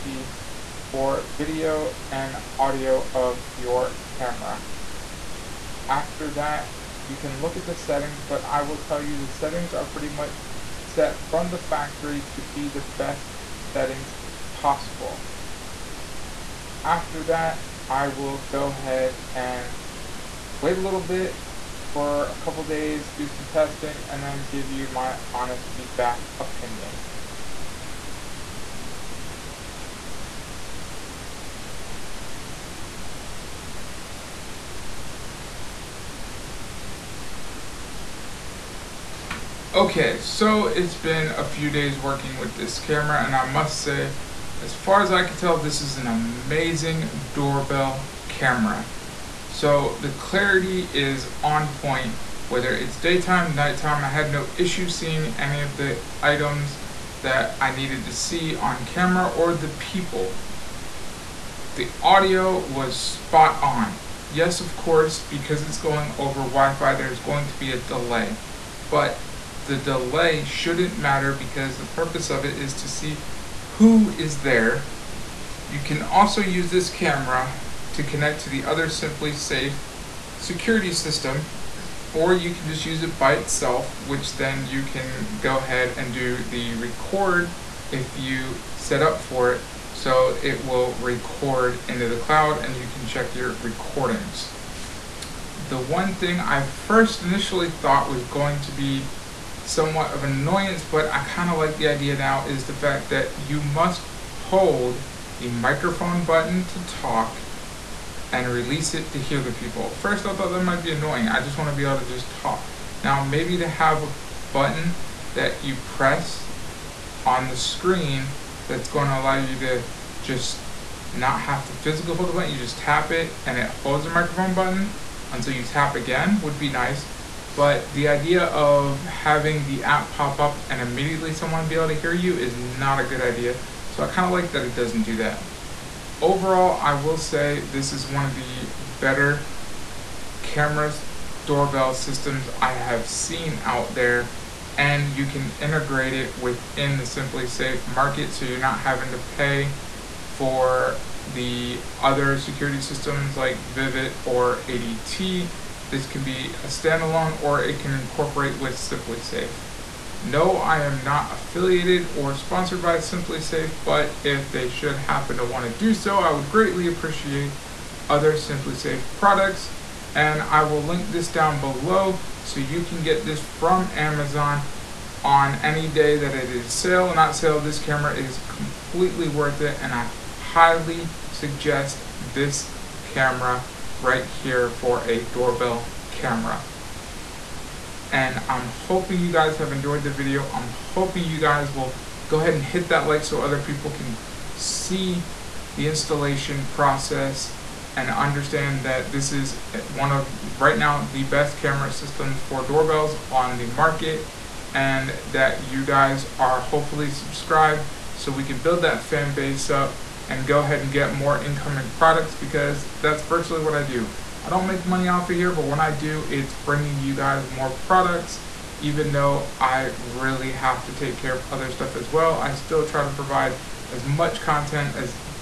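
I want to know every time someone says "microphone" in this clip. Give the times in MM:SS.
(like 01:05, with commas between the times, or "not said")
01:45, 02:04.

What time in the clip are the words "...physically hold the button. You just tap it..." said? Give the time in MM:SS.
02:01.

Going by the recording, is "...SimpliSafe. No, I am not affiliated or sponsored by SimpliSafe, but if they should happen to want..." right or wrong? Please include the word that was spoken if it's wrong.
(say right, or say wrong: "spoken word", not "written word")
right.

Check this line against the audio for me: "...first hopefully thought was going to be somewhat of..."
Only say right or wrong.
wrong.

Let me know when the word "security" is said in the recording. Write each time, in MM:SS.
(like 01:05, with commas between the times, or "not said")
01:20, 02:32.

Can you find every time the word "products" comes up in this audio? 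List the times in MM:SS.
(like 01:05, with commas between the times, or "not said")
02:49, 03:31, 03:37.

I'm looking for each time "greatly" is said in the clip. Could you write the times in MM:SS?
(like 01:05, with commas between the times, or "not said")
02:46.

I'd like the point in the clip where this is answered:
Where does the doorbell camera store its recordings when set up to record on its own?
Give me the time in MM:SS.
01:32.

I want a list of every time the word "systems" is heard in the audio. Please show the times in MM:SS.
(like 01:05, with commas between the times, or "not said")
01:20, 02:21, 02:32, 03:21.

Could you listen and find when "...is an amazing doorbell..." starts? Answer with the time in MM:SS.
00:45.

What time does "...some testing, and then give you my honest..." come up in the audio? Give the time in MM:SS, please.
00:23.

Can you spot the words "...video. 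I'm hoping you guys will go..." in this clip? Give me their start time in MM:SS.
03:10.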